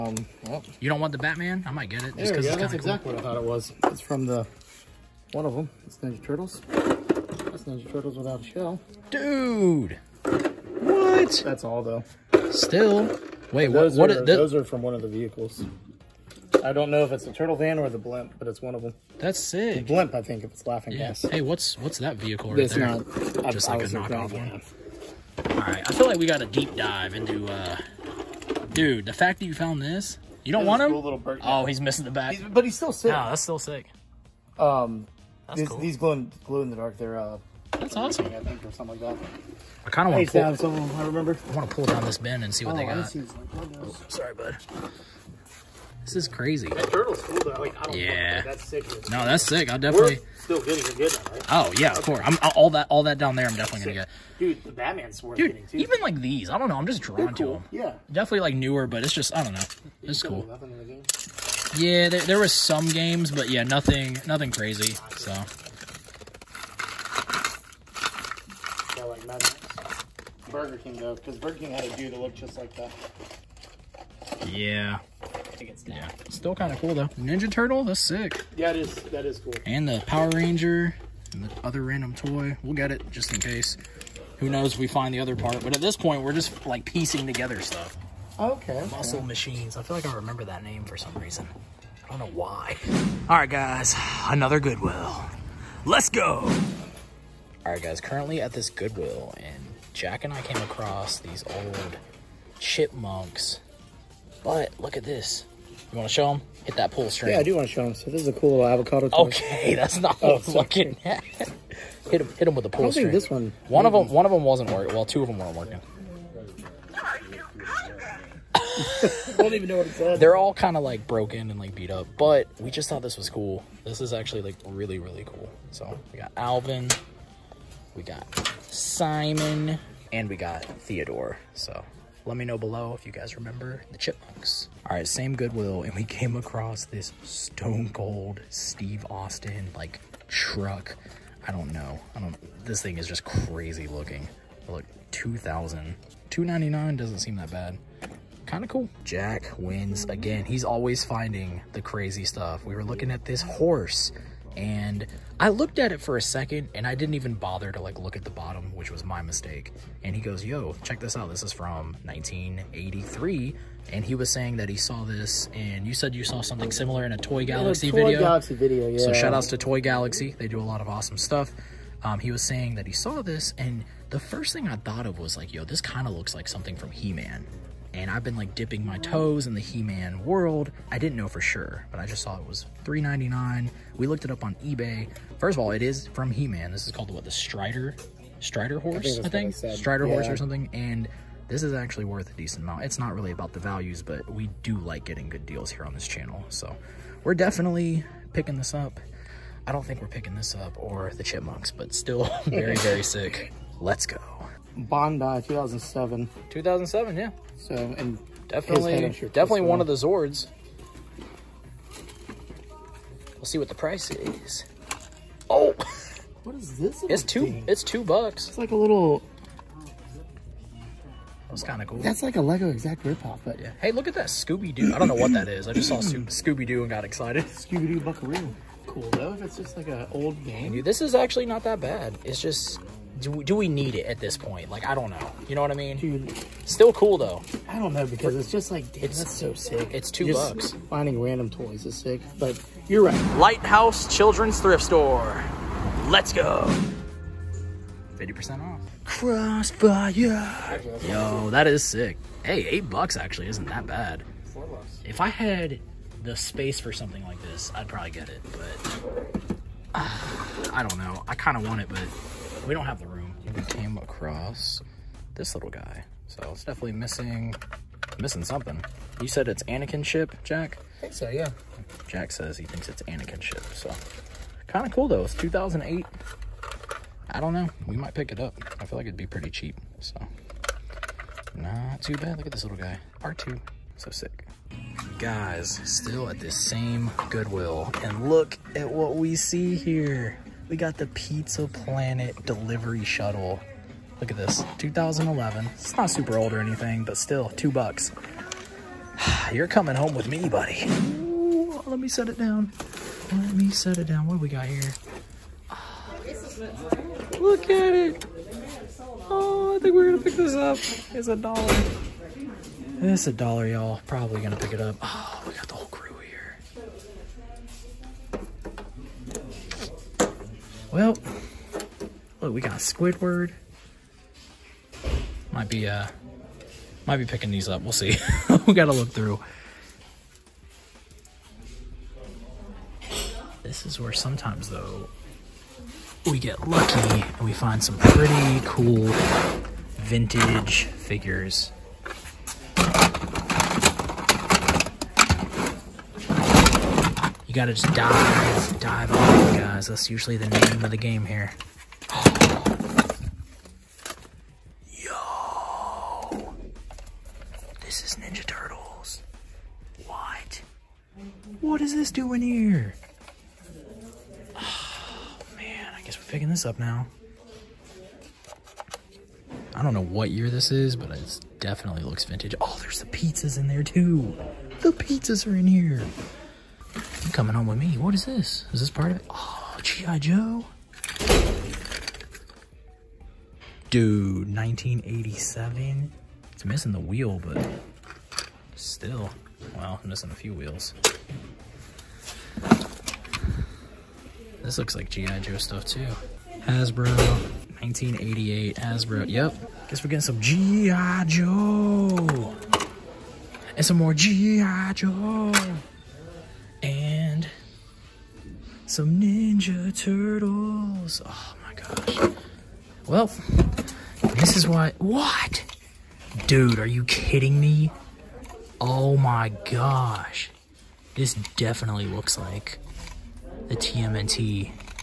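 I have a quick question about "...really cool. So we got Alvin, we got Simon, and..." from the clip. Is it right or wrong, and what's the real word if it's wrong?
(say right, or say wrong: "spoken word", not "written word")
right.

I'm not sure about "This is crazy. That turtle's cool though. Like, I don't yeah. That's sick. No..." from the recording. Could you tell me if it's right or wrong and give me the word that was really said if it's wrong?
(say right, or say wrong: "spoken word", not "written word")
right.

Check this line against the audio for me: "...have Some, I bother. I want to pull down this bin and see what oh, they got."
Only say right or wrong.
wrong.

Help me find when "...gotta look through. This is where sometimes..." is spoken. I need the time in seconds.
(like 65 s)
328 s.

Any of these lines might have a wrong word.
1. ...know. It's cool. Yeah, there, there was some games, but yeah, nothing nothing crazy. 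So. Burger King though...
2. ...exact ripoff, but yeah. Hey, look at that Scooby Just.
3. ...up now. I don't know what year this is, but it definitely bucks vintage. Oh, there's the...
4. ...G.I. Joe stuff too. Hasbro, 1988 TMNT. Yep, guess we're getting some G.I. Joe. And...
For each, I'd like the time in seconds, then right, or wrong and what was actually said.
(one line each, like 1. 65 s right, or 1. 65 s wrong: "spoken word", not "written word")
1. 59 s right
2. 222 s wrong: "Doo", not "Just"
3. 366 s wrong: "looks", not "bucks"
4. 395 s wrong: "Hasbro", not "TMNT".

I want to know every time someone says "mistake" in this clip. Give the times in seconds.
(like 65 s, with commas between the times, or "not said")
159 s.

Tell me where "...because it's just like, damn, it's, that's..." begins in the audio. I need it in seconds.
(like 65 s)
238 s.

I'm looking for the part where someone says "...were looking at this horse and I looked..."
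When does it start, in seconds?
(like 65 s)
152 s.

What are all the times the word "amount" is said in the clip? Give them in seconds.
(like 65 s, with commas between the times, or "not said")
192 s.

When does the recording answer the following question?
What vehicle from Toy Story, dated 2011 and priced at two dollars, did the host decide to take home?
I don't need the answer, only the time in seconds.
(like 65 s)
291 s.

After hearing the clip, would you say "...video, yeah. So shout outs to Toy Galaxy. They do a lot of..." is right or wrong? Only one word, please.
right.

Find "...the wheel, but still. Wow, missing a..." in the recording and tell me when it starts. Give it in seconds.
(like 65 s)
386 s.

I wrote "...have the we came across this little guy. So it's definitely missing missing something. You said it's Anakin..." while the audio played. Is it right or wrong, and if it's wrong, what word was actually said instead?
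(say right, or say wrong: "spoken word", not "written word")
right.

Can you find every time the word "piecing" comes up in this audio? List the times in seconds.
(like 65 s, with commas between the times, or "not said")
86 s.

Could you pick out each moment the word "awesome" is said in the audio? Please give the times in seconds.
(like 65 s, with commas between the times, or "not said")
37 s, 170 s.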